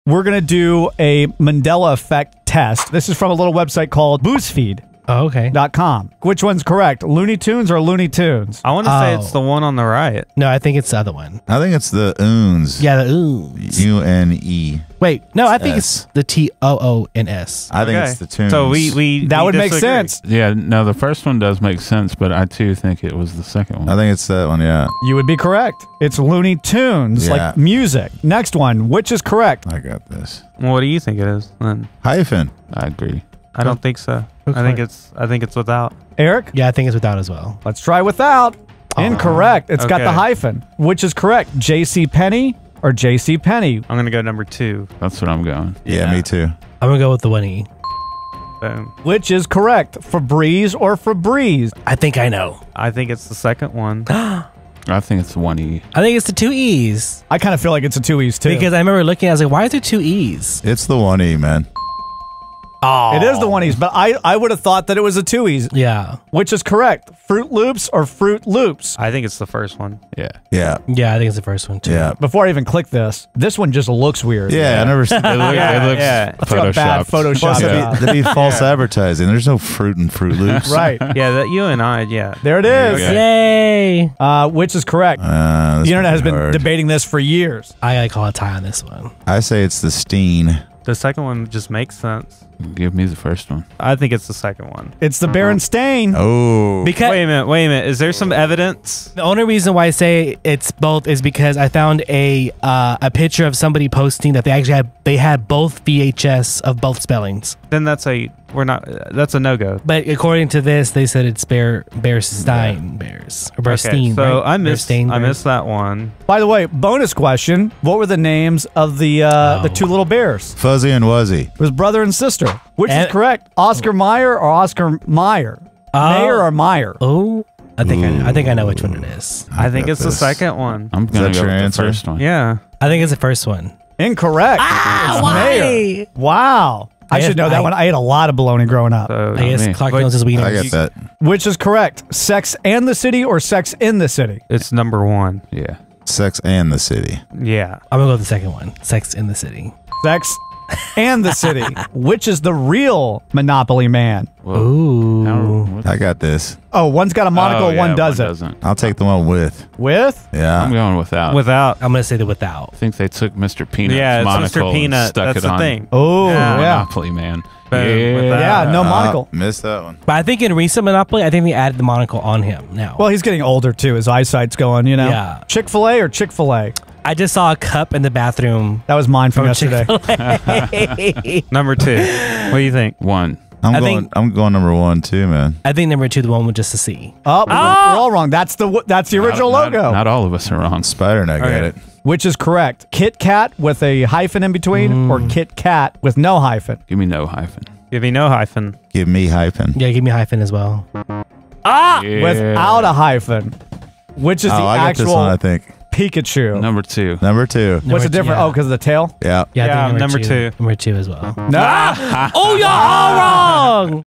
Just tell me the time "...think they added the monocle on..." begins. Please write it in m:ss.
2:51.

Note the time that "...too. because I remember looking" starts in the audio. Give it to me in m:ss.
0:58.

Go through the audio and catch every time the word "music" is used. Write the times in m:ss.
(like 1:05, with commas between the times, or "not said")
0:27.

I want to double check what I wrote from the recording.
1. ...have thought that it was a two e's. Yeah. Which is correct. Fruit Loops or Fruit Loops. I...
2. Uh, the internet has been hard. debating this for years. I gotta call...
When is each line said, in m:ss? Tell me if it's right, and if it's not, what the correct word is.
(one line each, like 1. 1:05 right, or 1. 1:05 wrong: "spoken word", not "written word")
1. 1:04 right
2. 1:25 right.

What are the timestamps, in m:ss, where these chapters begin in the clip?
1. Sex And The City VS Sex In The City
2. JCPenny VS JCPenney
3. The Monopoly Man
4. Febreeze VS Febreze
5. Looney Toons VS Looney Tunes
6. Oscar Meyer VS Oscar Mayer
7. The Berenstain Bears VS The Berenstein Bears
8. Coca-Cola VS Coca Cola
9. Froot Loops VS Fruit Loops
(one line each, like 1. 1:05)
1. 2:23
2. 0:42
3. 2:34
4. 0:52
5. 0:10
6. 2:03
7. 1:31
8. 0:30
9. 1:07.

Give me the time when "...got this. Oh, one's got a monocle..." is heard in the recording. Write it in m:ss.
2:35.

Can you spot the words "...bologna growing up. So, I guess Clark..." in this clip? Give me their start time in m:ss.
2:18.